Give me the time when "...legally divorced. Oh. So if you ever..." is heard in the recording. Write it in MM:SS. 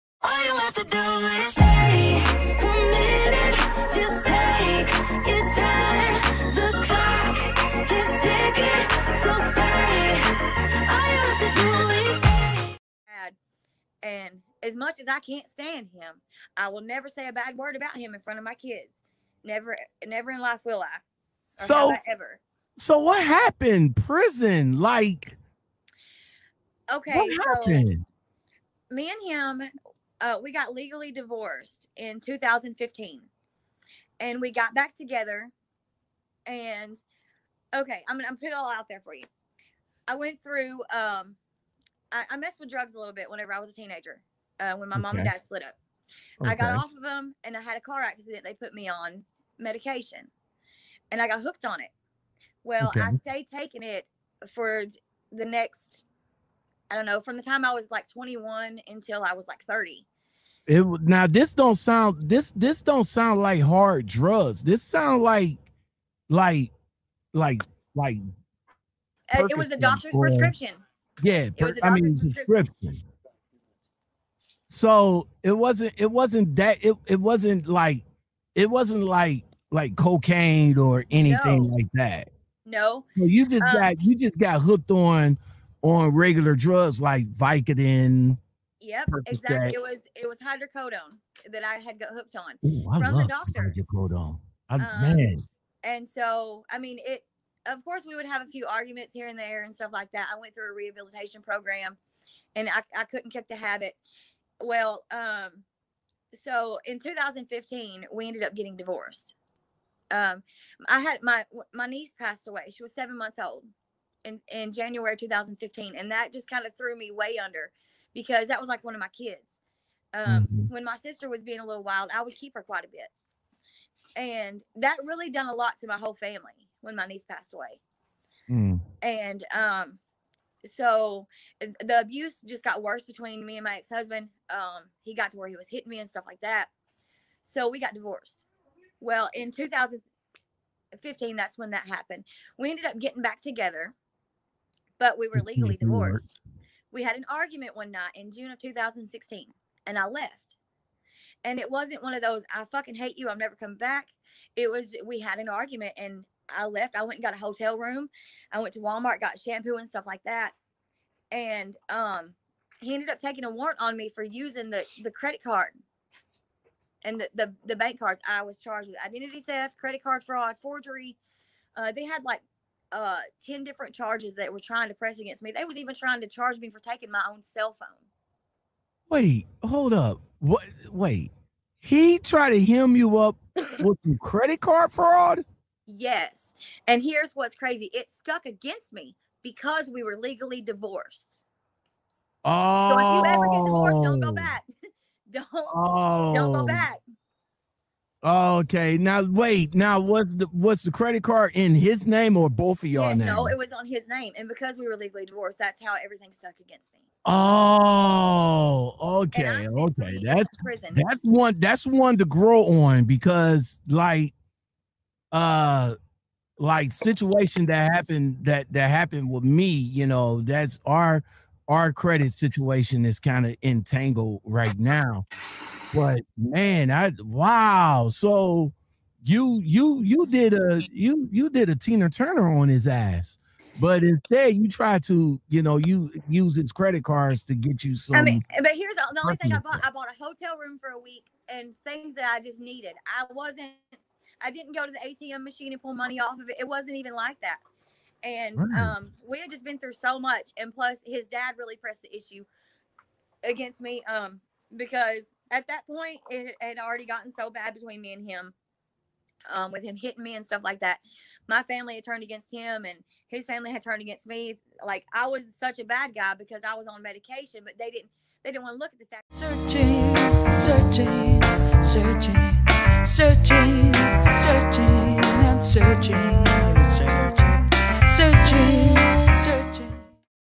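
03:10.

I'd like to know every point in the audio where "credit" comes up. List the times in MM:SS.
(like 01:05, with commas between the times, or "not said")
02:45, 02:49, 03:04, 03:20, 03:41, 03:56.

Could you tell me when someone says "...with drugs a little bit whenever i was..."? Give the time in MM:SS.
00:42.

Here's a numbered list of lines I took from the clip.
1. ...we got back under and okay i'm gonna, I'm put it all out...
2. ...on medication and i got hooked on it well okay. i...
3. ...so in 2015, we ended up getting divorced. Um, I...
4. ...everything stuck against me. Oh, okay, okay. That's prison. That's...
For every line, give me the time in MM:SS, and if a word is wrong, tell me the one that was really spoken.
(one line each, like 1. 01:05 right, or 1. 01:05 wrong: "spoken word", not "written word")
1. 00:34 wrong: "together", not "under"
2. 00:48 right
3. 01:46 right
4. 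03:26 right.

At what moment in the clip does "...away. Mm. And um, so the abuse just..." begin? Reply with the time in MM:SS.
02:07.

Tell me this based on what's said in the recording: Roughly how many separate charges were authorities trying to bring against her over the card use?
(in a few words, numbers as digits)
10.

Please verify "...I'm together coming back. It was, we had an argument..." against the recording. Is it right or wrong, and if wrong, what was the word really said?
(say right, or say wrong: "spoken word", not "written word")
wrong: "never", not "together".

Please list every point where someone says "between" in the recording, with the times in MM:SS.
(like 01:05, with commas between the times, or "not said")
02:13, 04:17.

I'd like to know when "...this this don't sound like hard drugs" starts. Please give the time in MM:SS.
01:02.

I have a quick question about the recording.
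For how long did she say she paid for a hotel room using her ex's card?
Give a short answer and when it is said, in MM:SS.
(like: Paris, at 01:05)
a week, at 04:00.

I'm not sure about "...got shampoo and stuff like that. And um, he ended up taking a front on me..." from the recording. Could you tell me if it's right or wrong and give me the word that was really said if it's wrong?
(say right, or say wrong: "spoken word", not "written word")
wrong: "warrant", not "front".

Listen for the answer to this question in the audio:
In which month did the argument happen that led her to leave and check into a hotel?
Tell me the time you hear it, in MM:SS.
02:28.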